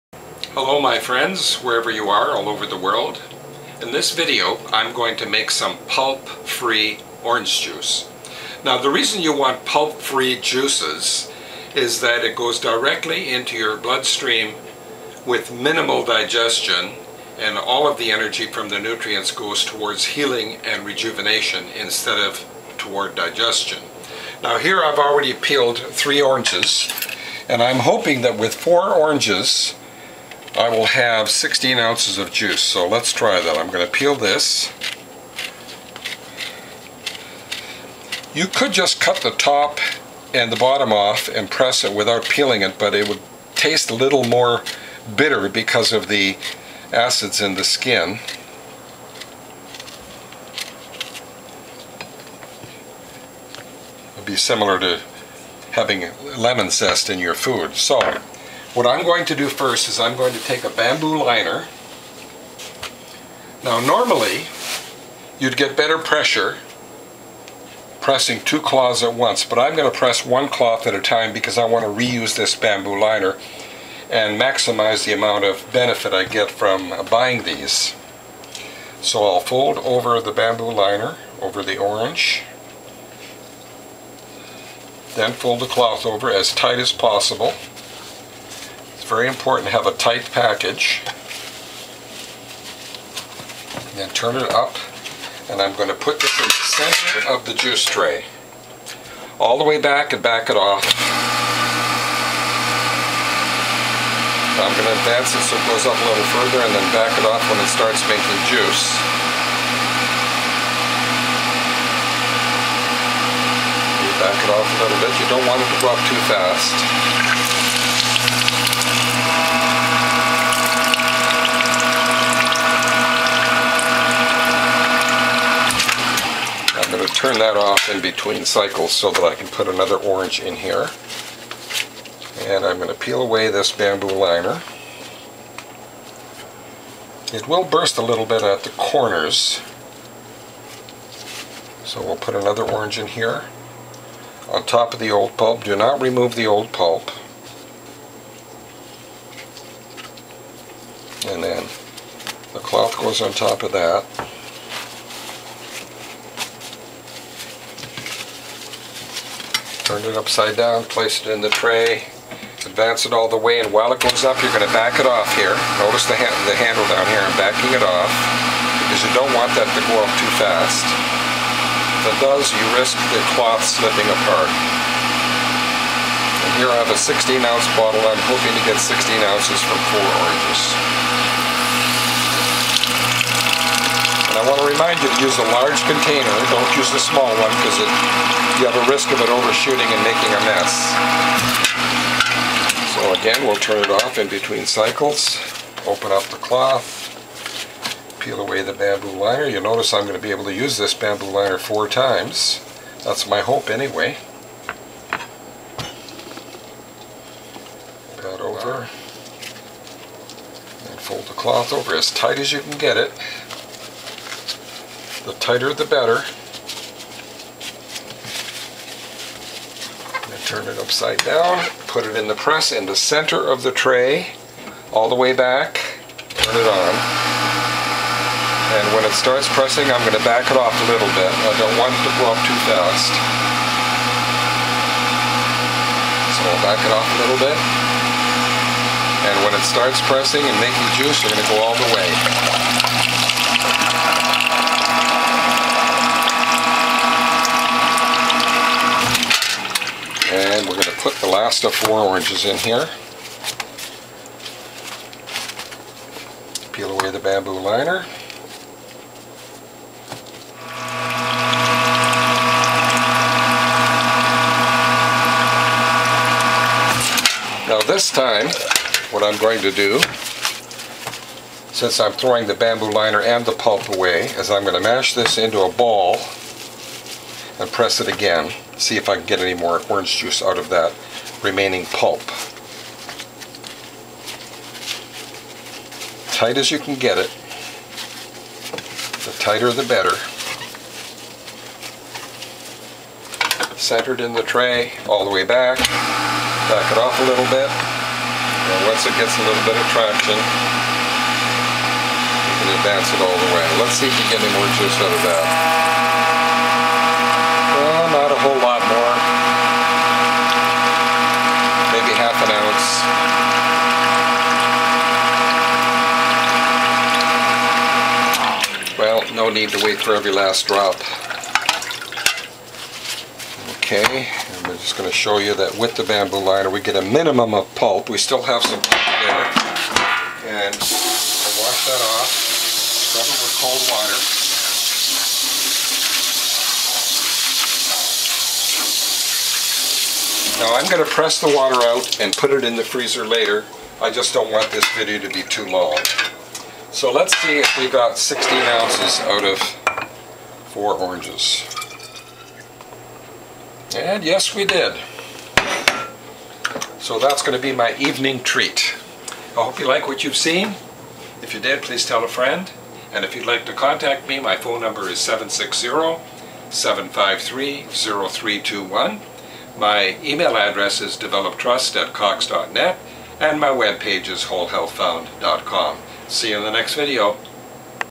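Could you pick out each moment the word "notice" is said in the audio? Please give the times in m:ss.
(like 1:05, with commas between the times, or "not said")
2:45, 3:19.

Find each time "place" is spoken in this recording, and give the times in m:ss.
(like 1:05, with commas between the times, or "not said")
2:40.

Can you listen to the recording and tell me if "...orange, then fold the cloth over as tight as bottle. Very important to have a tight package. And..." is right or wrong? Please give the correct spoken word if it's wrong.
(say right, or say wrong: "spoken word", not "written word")
wrong: "possible", not "bottle".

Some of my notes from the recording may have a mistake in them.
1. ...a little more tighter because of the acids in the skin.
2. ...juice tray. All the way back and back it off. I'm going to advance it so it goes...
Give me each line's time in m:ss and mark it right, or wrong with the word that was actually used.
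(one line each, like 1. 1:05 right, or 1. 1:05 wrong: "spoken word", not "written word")
1. 0:43 wrong: "bitter", not "tighter"
2. 1:37 right.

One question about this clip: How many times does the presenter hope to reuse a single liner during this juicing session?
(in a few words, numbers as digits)
4 times.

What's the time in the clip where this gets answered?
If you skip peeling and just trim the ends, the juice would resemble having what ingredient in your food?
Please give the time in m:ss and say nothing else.
0:56.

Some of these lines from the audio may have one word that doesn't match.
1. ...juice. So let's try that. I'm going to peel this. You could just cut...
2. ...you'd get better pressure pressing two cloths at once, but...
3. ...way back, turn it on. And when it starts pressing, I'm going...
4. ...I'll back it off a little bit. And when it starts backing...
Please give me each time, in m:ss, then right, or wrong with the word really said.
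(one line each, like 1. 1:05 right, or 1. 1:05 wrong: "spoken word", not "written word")
1. 0:32 right
2. 1:05 right
3. 3:45 right
4. 3:56 wrong: "pressing", not "backing".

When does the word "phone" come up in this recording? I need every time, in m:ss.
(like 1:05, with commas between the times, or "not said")
6:04.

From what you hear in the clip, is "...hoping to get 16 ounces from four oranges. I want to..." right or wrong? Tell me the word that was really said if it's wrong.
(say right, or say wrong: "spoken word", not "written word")
right.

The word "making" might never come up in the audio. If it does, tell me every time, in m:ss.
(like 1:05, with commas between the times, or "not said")
1:48, 3:10, 4:00.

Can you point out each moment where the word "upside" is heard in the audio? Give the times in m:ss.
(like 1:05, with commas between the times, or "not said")
2:40, 3:40.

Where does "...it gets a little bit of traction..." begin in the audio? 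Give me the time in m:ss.
4:59.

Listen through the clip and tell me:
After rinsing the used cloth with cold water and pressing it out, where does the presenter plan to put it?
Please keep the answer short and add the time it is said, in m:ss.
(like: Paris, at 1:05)
the freezer, at 5:42.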